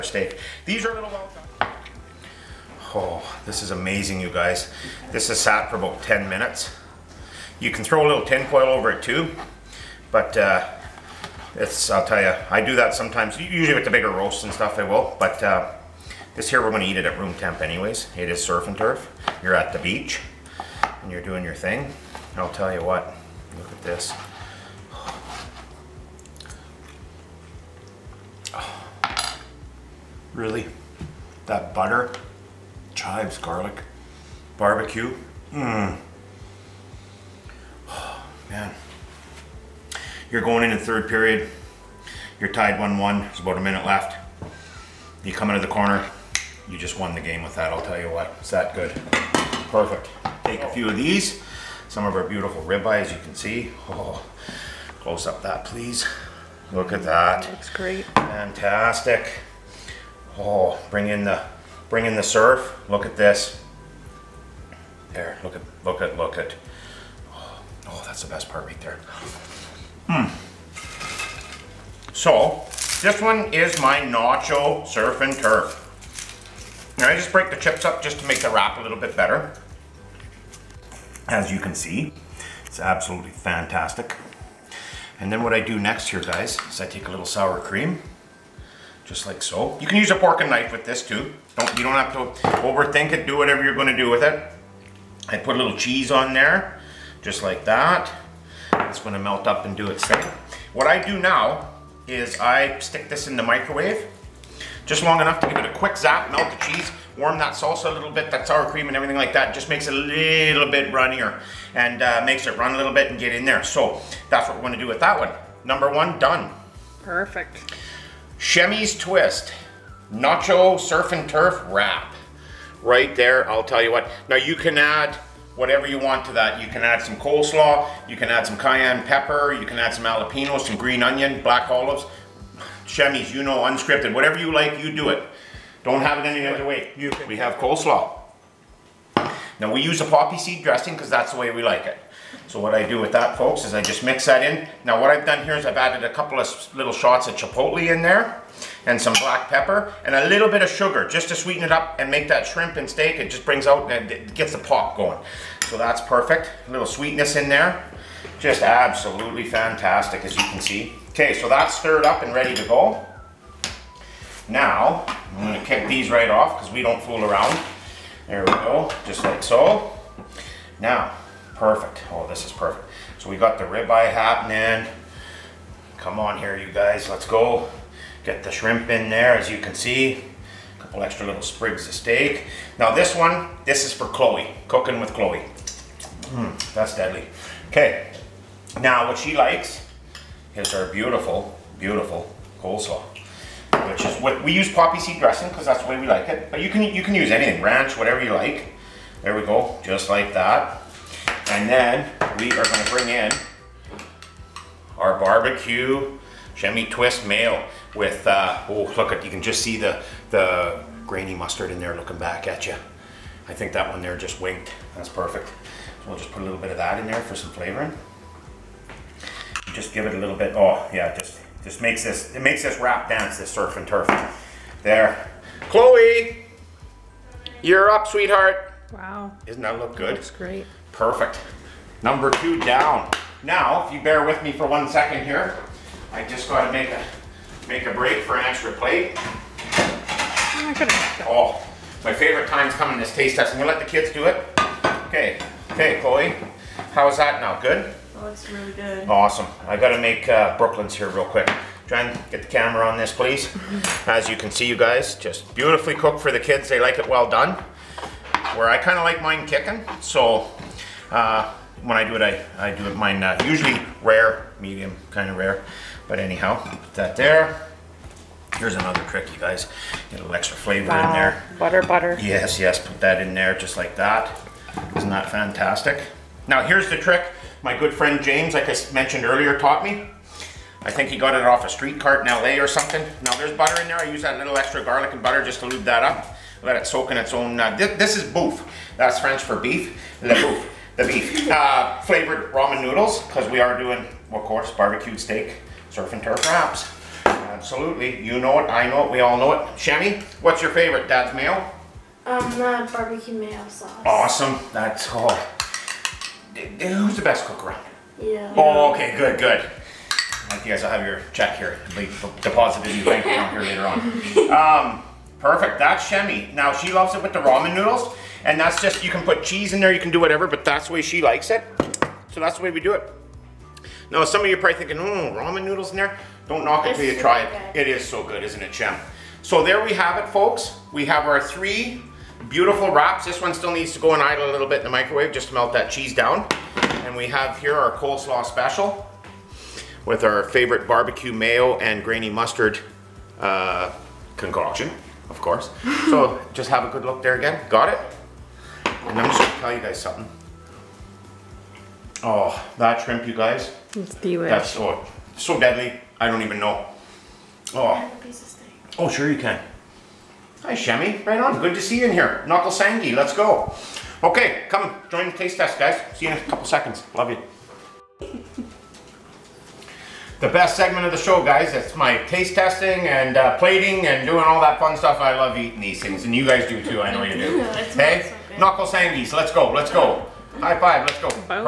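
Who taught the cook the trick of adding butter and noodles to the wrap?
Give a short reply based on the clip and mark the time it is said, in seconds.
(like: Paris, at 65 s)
James, at 278 s.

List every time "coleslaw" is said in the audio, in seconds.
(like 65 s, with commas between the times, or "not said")
127 s, 137 s, 192 s, 337 s.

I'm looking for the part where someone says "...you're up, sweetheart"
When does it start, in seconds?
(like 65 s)
227 s.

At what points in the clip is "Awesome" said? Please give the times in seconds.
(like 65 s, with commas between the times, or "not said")
249 s, 304 s.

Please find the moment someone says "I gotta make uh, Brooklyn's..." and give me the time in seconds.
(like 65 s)
249 s.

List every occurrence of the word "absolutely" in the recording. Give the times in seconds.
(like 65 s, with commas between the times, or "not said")
82 s, 158 s, 297 s.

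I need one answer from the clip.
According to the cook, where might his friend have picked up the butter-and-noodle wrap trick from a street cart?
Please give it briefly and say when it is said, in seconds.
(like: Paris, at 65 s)
LA, at 282 s.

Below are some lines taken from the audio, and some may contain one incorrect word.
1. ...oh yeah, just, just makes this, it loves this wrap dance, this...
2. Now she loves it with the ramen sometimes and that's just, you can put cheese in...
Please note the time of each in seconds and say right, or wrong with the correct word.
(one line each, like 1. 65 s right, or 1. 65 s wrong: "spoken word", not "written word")
1. 220 s wrong: "makes", not "loves"
2. 316 s wrong: "noodles", not "sometimes".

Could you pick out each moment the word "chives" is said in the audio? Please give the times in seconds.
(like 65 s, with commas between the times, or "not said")
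32 s.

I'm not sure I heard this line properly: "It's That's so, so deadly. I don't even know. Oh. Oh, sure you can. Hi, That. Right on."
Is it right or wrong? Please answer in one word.
wrong.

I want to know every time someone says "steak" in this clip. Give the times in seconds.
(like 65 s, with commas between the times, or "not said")
0 s, 152 s, 181 s, 295 s.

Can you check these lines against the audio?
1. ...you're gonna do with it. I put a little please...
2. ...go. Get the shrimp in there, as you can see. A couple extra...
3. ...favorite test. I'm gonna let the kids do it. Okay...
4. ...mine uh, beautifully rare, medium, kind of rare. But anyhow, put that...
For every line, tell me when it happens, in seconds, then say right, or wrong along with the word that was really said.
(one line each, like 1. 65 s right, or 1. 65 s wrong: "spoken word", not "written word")
1. 93 s wrong: "cheese", not "please"
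2. 177 s right
3. 243 s wrong: "taste", not "favorite"
4. 262 s wrong: "usually", not "beautifully".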